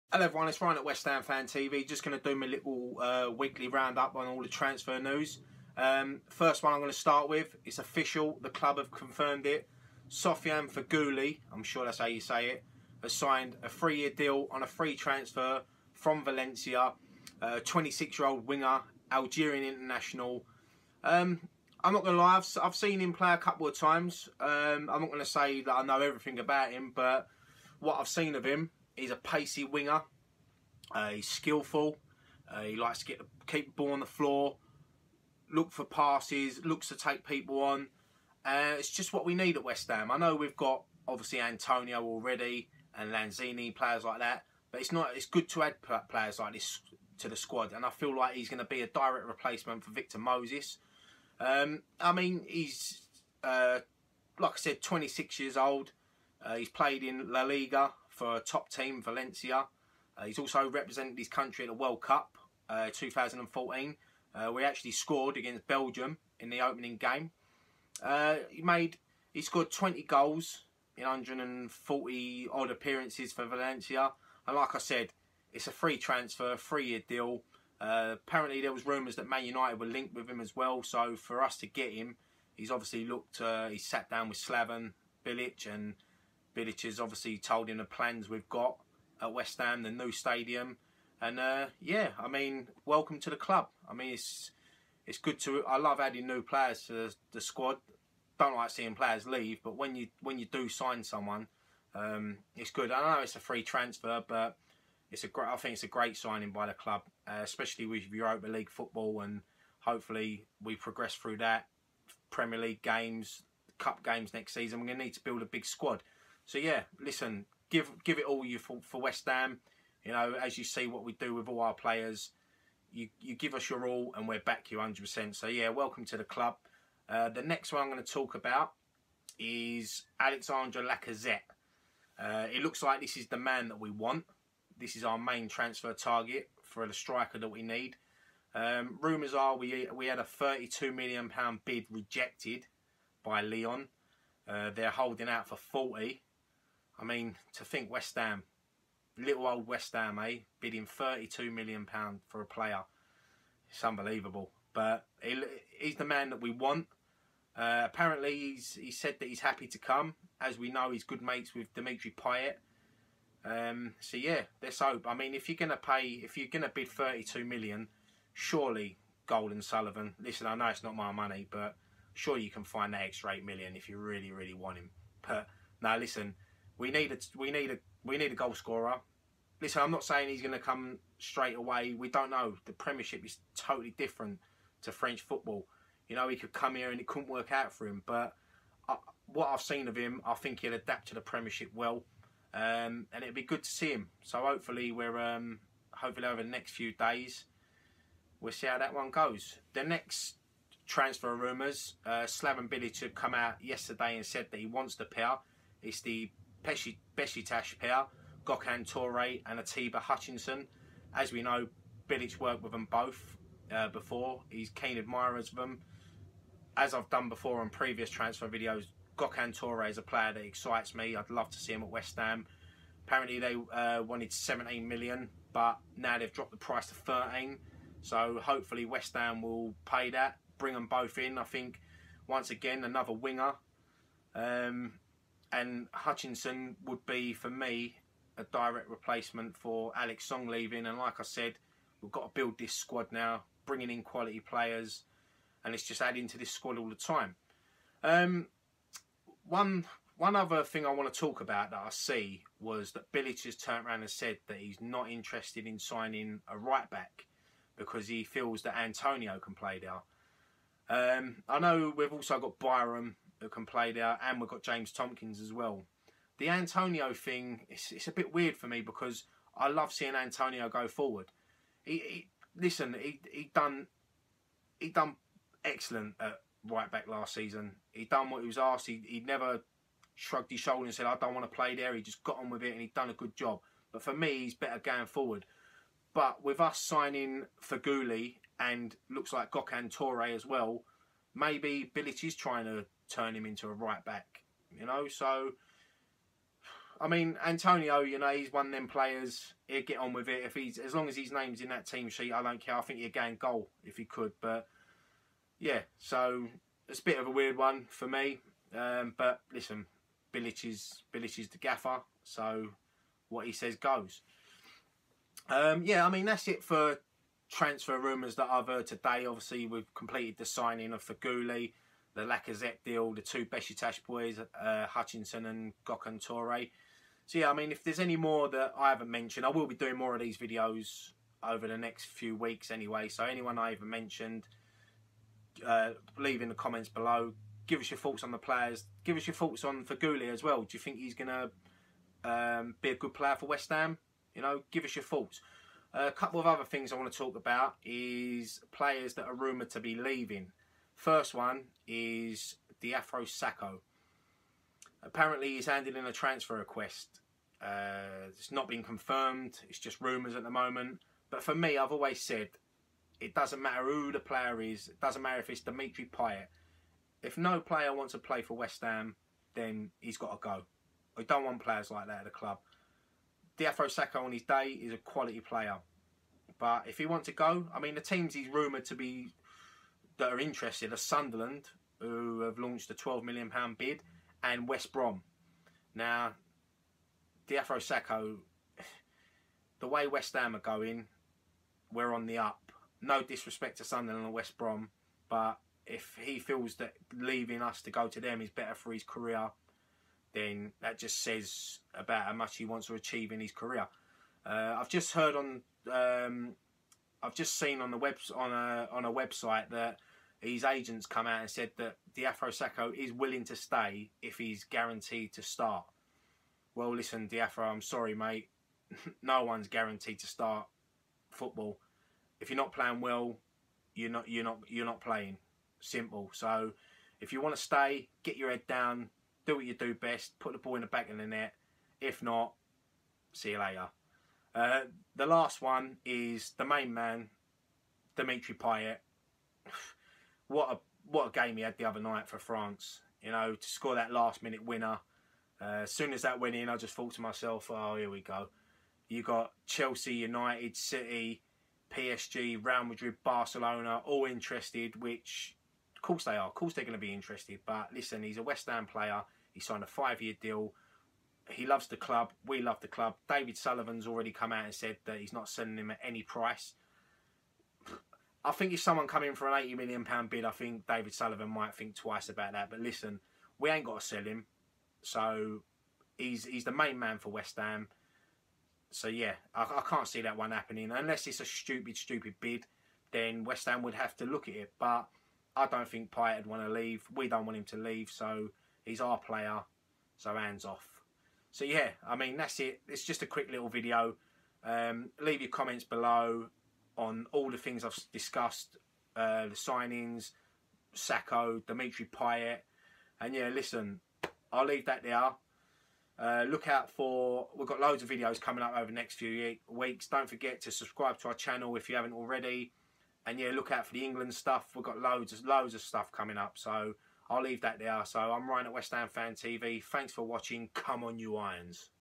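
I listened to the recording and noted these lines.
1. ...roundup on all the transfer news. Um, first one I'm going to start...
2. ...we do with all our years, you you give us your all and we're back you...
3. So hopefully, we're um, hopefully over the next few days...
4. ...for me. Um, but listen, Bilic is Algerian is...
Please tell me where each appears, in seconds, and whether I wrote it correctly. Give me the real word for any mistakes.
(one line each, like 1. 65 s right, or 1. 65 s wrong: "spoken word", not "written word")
1. 3 s right
2. 121 s wrong: "players", not "years"
3. 194 s right
4. 307 s wrong: "Bilic", not "Algerian".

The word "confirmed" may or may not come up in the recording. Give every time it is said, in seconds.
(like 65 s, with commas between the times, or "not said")
8 s, 358 s.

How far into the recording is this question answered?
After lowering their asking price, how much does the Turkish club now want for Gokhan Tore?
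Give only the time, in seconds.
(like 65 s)
226 s.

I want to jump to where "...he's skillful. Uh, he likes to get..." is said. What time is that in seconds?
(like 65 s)
31 s.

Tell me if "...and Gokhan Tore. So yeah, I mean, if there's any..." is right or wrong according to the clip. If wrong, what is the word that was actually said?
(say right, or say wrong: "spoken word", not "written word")
right.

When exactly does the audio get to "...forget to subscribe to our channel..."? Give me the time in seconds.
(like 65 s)
510 s.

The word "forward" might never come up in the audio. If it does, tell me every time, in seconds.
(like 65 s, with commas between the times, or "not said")
270 s, 285 s.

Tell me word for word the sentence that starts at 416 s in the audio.
Well, listen, Diafro, I'm sorry, mate.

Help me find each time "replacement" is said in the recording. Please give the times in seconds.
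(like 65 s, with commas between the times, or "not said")
49 s, 238 s.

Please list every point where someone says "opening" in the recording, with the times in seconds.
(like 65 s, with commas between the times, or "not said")
66 s.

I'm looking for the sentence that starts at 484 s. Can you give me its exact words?
But I don't think Payet would want to leave.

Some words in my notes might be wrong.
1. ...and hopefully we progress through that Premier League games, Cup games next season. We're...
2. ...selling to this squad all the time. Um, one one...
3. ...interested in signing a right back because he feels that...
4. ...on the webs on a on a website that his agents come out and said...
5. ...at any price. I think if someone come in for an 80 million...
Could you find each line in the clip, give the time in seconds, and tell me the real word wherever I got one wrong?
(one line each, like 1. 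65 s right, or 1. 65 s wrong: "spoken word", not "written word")
1. 109 s right
2. 246 s wrong: "adding", not "selling"
3. 255 s right
4. 407 s right
5. 465 s right.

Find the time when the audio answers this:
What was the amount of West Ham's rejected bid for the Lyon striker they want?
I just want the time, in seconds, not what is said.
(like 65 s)
140 s.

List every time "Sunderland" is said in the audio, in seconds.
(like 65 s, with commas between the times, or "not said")
380 s, 393 s.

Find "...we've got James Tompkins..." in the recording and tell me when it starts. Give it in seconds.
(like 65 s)
264 s.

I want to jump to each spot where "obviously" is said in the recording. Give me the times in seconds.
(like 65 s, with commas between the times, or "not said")
41 s, 82 s, 86 s, 319 s.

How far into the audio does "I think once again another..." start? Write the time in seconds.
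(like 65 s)
231 s.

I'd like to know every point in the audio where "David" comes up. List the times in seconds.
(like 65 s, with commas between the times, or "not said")
463 s, 470 s.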